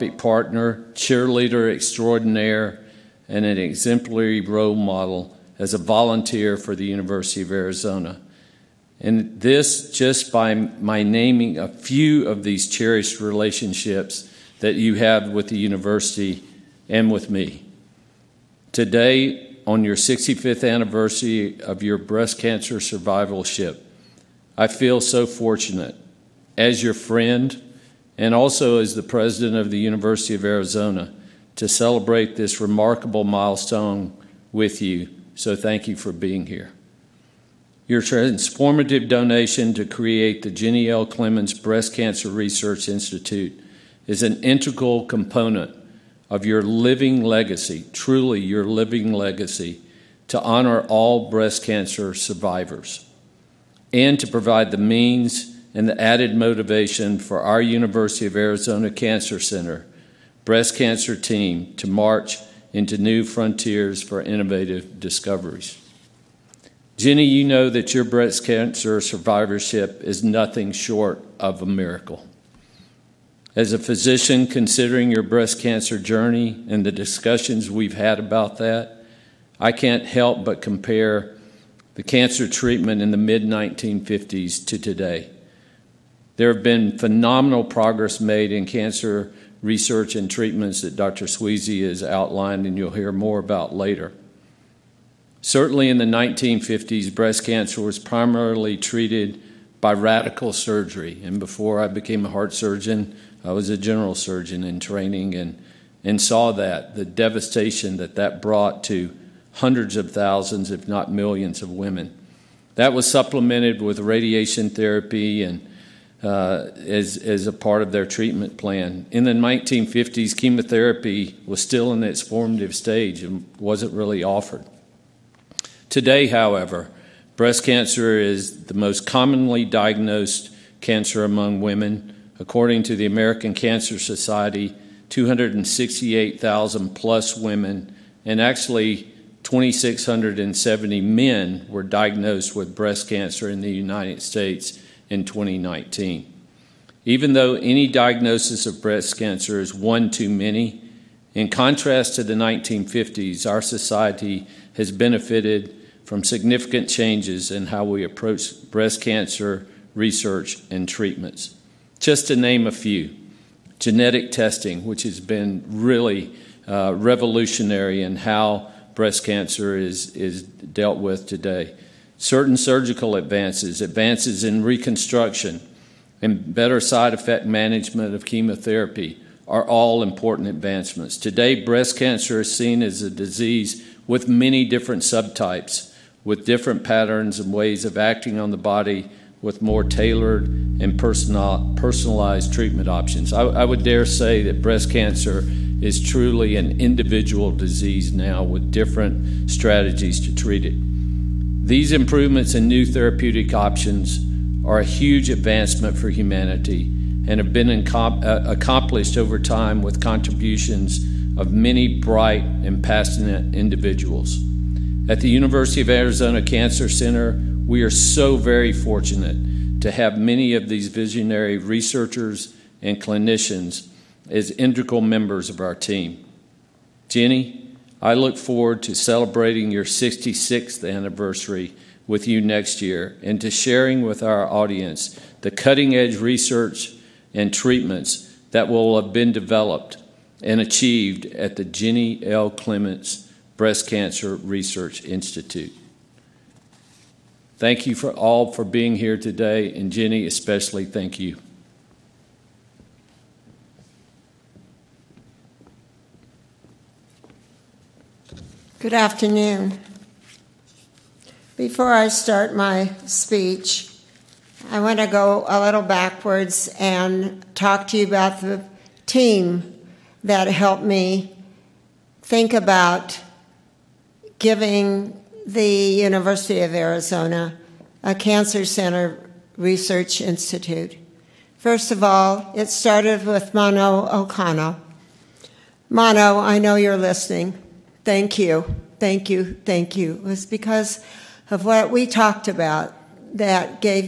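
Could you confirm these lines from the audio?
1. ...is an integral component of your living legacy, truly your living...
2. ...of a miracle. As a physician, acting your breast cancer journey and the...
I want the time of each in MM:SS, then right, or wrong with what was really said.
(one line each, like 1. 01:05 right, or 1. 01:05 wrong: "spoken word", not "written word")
1. 00:44 right
2. 01:11 wrong: "considering", not "acting".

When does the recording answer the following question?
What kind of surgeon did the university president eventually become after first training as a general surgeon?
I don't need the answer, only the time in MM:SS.
01:42.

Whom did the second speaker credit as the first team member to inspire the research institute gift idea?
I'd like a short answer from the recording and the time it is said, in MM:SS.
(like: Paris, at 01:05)
Mono O'Connell, at 04:43.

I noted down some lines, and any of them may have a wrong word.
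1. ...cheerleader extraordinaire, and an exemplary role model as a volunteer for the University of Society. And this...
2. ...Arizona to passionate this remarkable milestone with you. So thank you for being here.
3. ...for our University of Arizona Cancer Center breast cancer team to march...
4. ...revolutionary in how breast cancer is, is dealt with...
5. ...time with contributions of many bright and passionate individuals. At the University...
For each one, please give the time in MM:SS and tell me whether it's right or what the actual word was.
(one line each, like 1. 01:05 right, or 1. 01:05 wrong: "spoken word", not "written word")
1. 00:00 wrong: "Arizona", not "Society"
2. 00:30 wrong: "celebrate", not "passionate"
3. 00:57 right
4. 02:46 right
5. 03:29 right.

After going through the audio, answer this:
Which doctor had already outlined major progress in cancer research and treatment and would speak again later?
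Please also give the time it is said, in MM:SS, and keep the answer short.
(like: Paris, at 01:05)
Dr. Sweasy, at 01:30.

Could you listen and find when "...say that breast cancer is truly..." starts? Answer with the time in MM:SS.
03:14.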